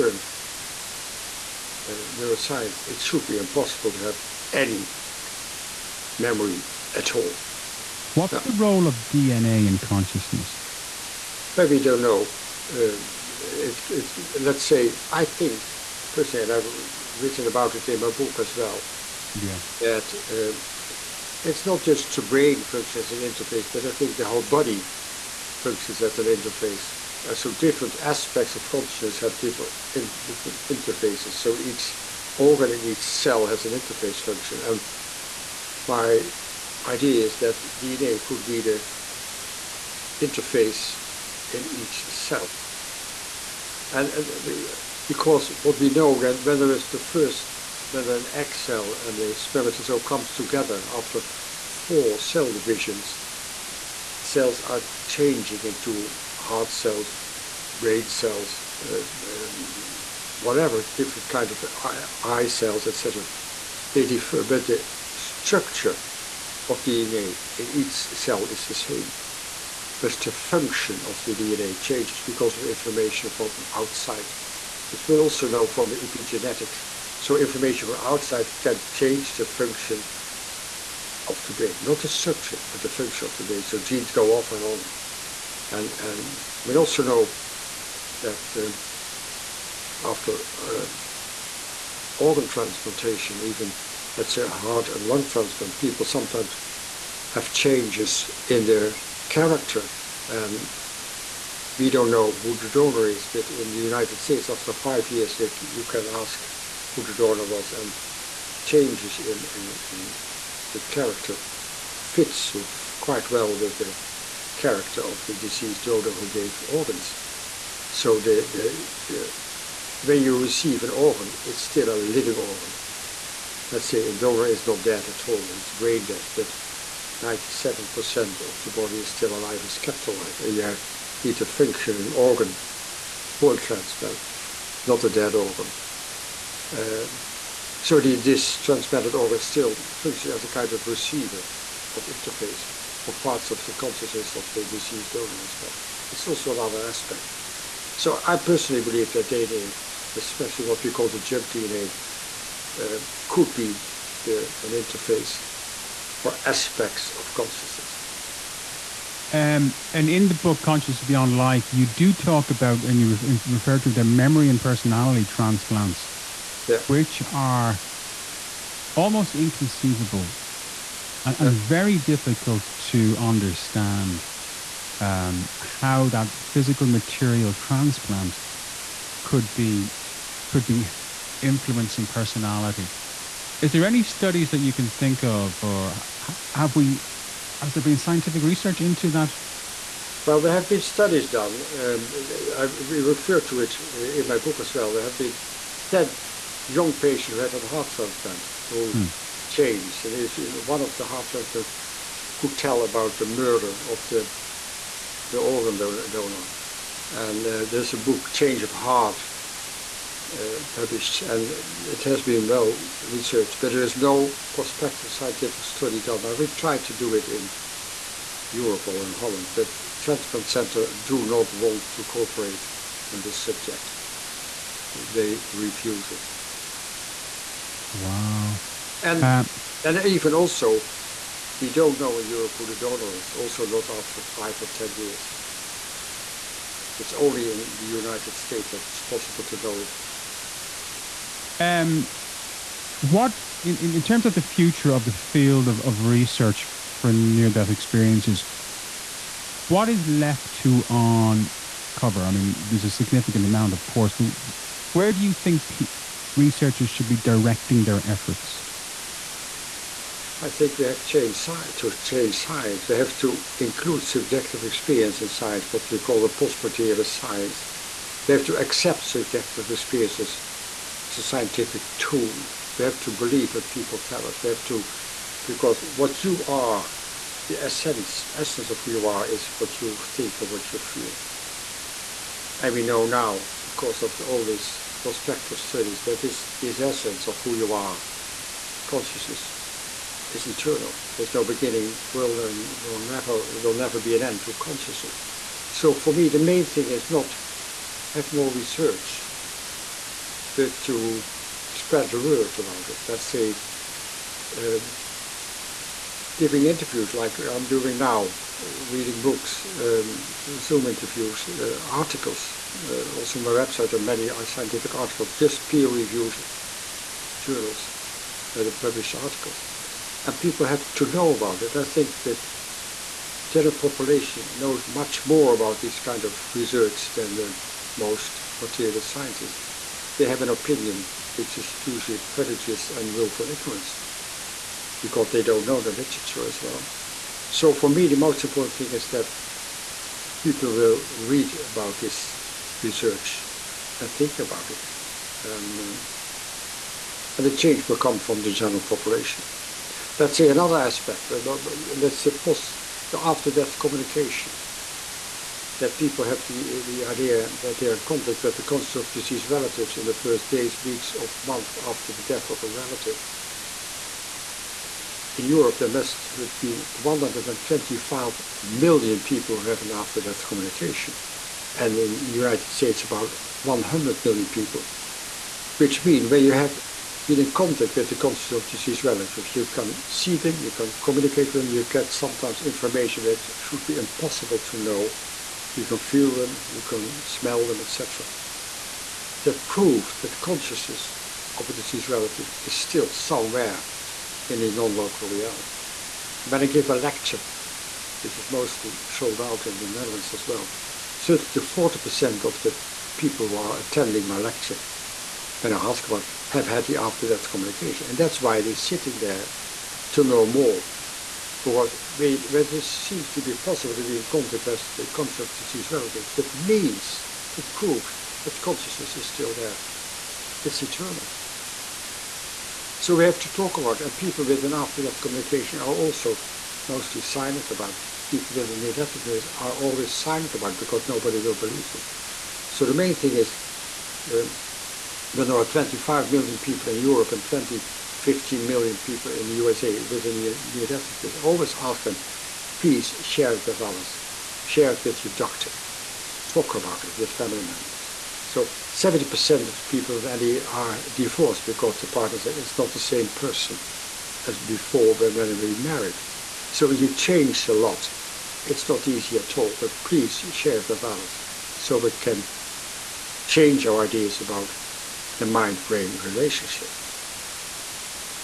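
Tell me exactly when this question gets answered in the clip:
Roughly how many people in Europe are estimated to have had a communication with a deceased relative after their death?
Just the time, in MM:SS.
06:06.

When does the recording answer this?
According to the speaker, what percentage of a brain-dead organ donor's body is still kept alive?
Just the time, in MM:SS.
02:07.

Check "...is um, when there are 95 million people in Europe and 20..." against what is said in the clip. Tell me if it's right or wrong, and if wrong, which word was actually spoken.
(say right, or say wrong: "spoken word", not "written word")
wrong: "25", not "95".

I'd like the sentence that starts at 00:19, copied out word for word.
Yeah, that um, it's not just the brain functions as an interface, but I think the whole body functions as an interface.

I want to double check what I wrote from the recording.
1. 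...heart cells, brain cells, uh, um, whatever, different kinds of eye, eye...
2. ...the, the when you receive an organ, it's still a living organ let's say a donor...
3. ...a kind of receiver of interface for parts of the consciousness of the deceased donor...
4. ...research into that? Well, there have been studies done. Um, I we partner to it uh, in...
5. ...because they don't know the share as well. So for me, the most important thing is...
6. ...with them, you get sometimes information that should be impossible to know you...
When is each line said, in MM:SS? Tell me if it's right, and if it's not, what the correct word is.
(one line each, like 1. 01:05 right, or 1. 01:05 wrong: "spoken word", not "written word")
1. 00:56 right
2. 01:58 right
3. 02:20 right
4. 03:08 wrong: "refer", not "partner"
5. 05:34 wrong: "literature", not "share"
6. 06:21 right.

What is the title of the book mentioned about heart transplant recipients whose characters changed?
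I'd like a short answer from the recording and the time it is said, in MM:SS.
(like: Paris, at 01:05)
Change of Heart, at 03:28.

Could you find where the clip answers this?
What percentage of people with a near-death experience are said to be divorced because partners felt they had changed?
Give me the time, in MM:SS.
07:28.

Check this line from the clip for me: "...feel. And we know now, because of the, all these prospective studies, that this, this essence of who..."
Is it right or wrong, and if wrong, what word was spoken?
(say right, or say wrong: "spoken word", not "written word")
right.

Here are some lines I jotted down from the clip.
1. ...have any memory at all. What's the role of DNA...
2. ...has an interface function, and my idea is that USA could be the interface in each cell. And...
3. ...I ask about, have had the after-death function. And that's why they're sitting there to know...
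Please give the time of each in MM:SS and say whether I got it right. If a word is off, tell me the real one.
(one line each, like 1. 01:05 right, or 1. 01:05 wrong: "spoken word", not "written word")
1. 00:04 right
2. 00:33 wrong: "DNA", not "USA"
3. 06:45 wrong: "communication", not "function".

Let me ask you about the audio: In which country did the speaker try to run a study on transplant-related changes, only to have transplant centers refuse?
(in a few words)
Holland.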